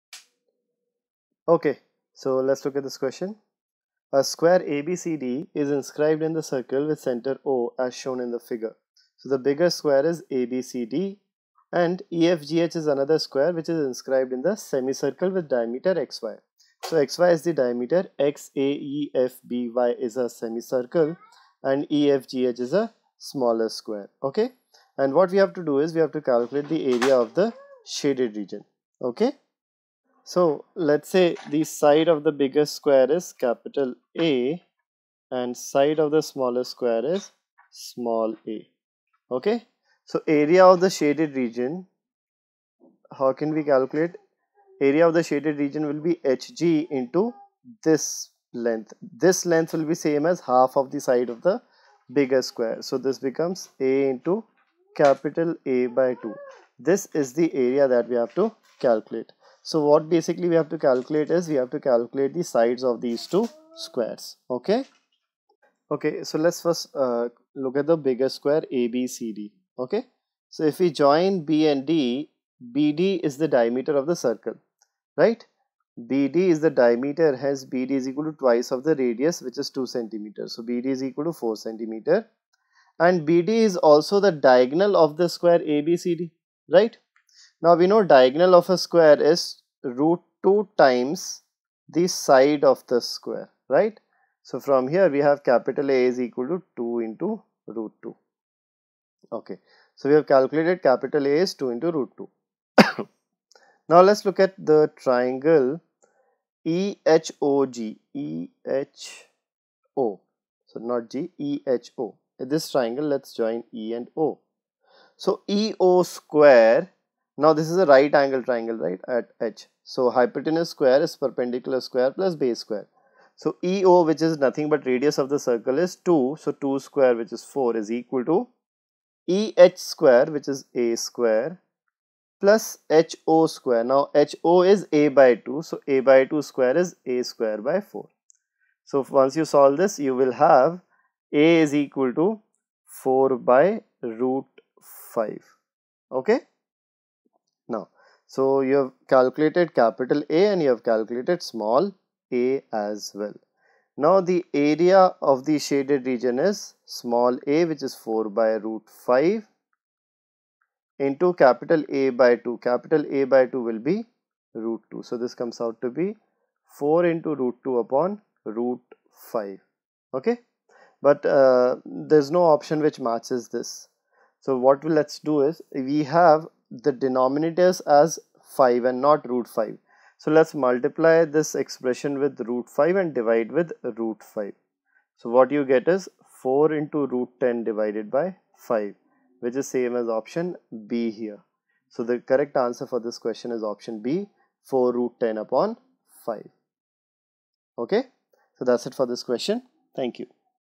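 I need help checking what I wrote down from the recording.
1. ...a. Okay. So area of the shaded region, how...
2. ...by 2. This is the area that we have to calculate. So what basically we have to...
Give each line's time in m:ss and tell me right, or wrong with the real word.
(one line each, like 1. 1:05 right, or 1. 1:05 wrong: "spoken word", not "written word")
1. 0:38 right
2. 0:55 right.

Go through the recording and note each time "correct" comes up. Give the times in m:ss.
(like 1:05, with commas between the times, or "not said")
3:12.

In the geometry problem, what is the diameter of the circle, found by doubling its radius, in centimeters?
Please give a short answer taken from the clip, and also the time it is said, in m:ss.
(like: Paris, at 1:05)
4 centimeters, at 1:21.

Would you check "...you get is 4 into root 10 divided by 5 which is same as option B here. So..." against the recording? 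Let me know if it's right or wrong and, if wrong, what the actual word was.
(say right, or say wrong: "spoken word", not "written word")
right.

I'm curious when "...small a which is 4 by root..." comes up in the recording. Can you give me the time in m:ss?
2:36.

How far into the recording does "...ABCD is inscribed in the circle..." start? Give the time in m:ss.
0:04.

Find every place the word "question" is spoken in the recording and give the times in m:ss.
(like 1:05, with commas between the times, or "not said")
0:02, 3:13, 3:19.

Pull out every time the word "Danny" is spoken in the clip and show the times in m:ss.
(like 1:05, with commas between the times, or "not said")
not said.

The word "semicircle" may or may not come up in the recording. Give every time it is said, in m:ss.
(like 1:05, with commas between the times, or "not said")
0:14, 0:20.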